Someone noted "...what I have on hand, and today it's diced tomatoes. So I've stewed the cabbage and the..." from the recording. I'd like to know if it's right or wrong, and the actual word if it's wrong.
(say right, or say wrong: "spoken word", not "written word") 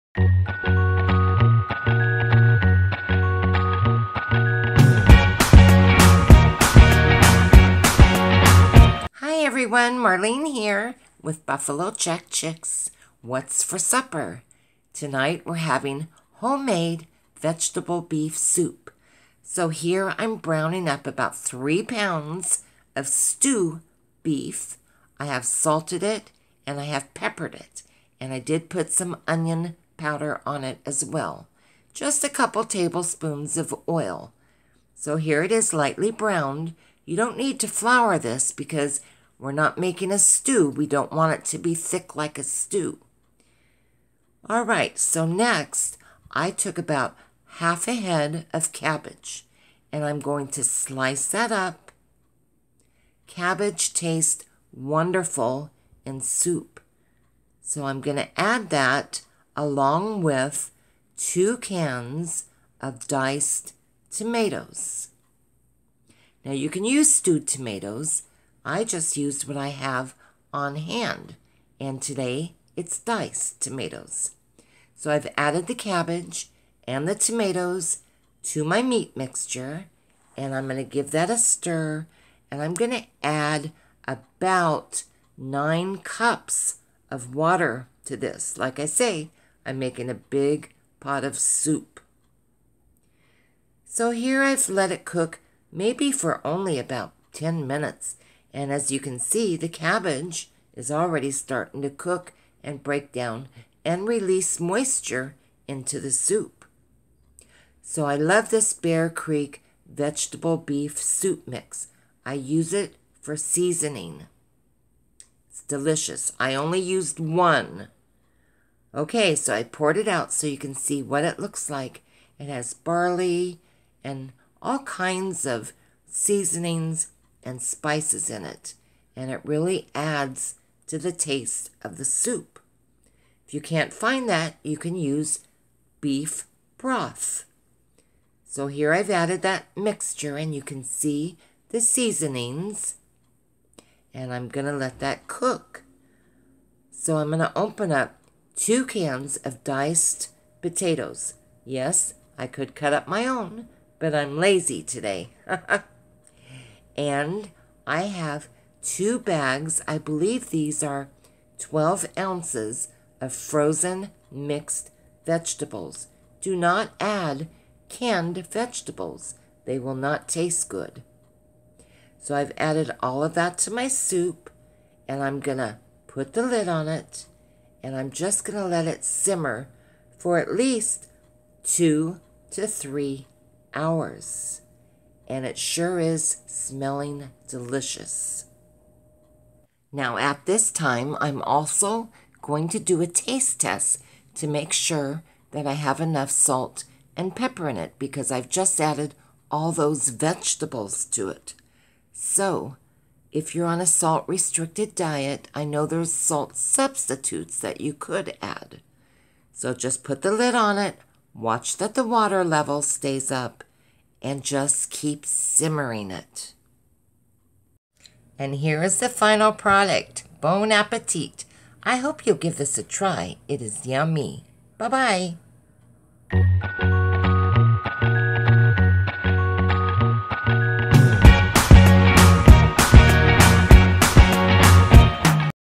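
wrong: "added", not "stewed".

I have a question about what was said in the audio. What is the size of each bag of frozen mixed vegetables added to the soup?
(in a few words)
12 ounces.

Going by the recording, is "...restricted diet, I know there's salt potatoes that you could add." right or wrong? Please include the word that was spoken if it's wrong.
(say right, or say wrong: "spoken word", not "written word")
wrong: "substitutes", not "potatoes".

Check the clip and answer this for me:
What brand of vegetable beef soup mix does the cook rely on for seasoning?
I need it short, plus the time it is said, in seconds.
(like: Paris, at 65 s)
Bear Creek, at 108 s.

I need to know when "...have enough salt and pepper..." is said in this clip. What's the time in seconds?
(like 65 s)
195 s.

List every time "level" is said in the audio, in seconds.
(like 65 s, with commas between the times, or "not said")
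212 s.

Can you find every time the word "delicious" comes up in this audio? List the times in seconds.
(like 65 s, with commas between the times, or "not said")
115 s, 187 s.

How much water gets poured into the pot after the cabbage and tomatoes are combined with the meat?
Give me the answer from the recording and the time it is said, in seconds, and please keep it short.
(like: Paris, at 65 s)
9 cups, at 85 s.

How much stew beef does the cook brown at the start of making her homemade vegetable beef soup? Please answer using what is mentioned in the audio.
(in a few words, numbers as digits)
3 pounds.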